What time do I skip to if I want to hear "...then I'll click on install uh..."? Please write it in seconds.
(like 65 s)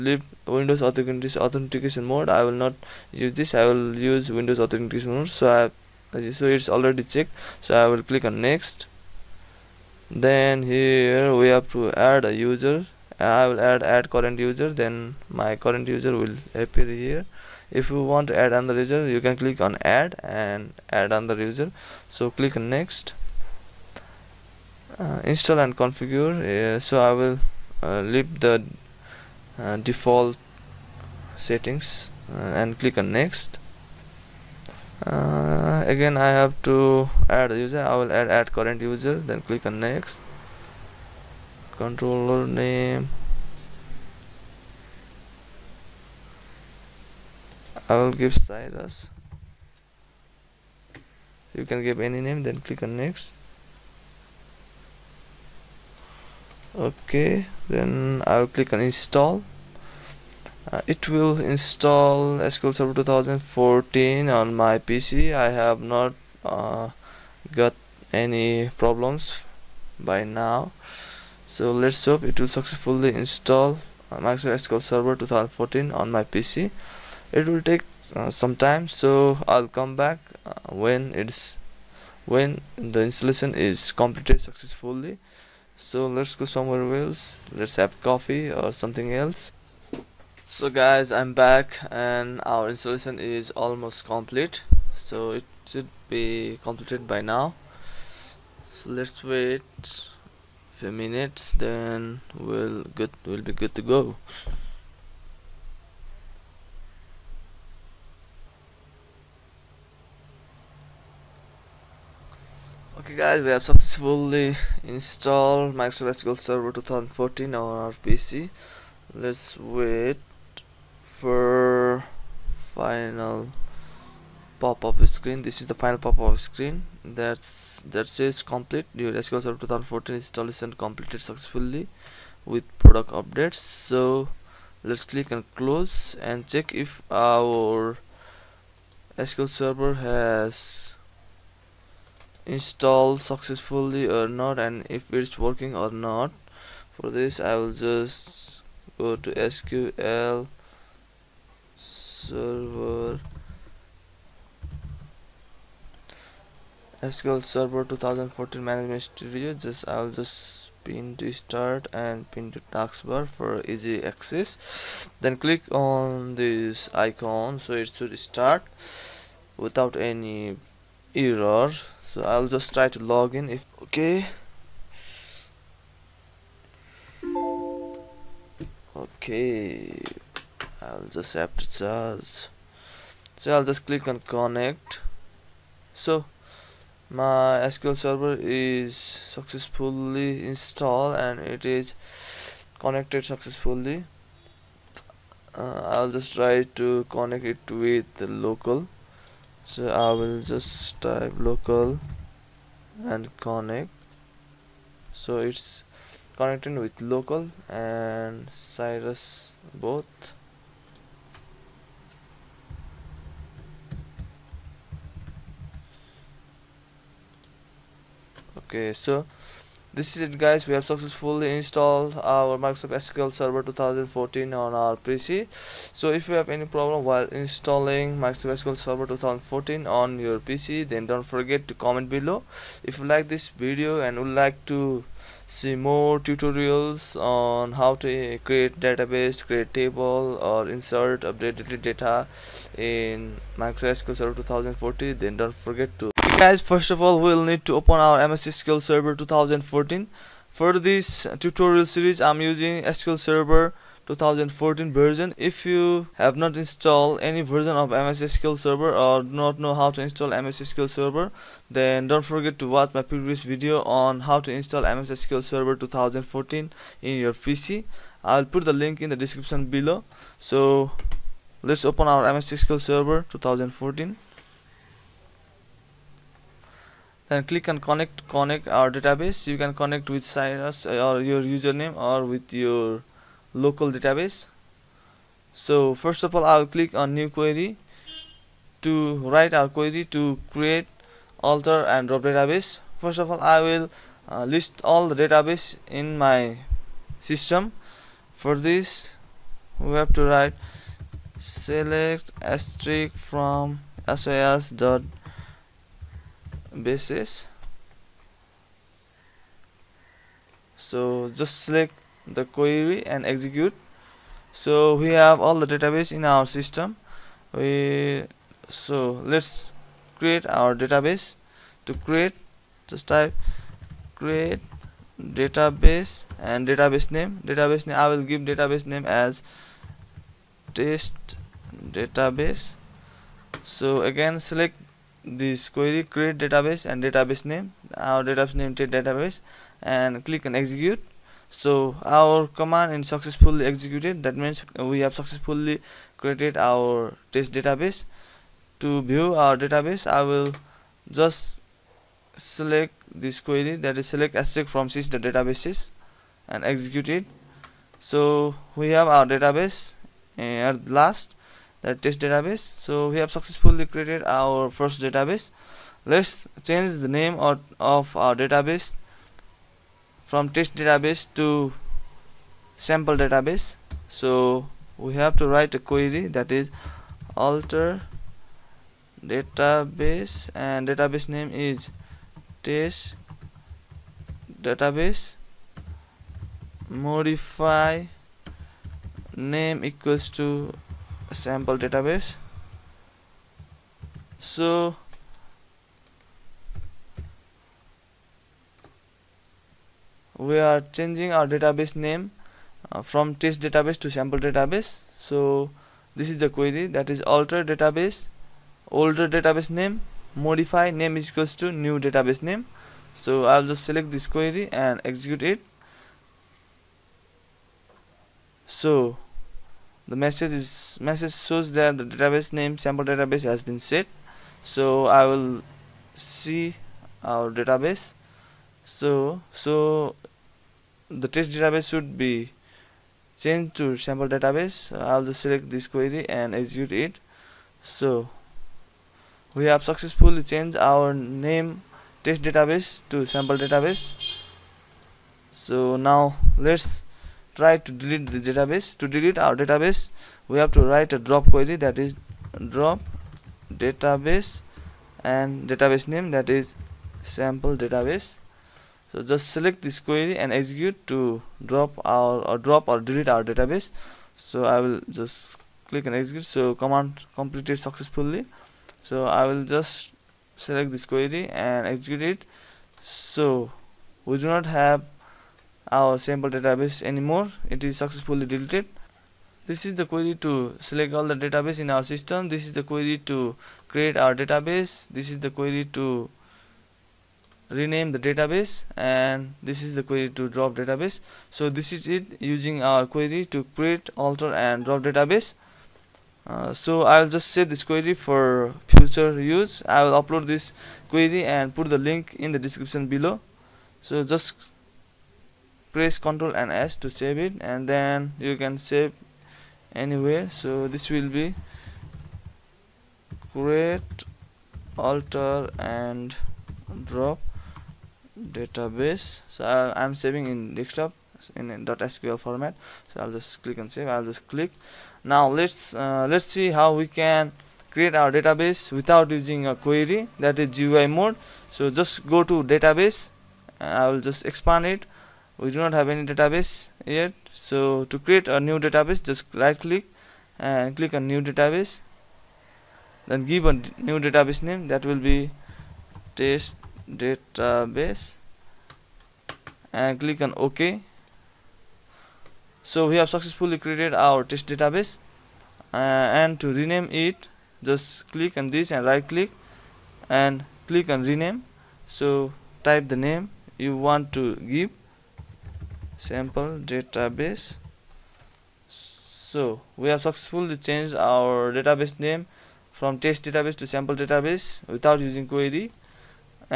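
57 s.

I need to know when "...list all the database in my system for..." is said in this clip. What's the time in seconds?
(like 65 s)
294 s.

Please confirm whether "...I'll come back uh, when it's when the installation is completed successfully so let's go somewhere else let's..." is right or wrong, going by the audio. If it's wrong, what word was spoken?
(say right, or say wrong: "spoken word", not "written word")
right.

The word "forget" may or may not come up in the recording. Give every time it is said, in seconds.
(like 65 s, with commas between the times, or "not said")
231 s, 245 s, 262 s.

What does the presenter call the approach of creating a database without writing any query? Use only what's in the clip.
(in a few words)
GUI mode.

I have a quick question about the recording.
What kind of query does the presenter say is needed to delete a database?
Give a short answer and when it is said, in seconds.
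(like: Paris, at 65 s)
drop query, at 451 s.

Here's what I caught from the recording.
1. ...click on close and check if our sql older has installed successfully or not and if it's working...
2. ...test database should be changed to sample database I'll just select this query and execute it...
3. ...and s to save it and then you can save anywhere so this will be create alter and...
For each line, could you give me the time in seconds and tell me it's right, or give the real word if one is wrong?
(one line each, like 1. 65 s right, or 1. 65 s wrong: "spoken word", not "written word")
1. 135 s wrong: "server", not "older"
2. 431 s right
3. 506 s right.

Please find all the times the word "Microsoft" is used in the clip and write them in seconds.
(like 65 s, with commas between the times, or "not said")
74 s, 115 s, 222 s, 228 s, 243 s.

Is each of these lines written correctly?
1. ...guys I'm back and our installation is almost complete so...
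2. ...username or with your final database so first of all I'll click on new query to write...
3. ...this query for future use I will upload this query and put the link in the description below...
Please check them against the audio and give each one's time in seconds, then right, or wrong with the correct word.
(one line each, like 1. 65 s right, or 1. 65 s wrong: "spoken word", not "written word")
1. 90 s right
2. 281 s wrong: "local", not "final"
3. 497 s right.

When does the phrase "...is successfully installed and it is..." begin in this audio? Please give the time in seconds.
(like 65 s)
188 s.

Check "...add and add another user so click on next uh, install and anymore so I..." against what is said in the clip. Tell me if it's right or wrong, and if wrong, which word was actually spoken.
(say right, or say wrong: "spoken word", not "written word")
wrong: "configure", not "anymore".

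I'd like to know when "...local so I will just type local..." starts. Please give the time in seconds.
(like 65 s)
198 s.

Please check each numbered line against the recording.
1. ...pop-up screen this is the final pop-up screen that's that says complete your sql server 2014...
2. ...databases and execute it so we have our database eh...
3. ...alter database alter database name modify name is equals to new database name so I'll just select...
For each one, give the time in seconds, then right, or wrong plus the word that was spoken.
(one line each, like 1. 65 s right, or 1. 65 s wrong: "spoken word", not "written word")
1. 124 s right
2. 355 s right
3. 407 s wrong: "older", not "alter".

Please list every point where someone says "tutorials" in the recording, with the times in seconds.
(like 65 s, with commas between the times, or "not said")
236 s, 251 s.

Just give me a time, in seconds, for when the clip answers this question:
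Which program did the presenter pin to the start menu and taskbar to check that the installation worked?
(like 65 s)
157 s.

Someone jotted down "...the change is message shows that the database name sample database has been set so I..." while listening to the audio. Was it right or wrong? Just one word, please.
wrong.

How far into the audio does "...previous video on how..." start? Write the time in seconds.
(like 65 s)
263 s.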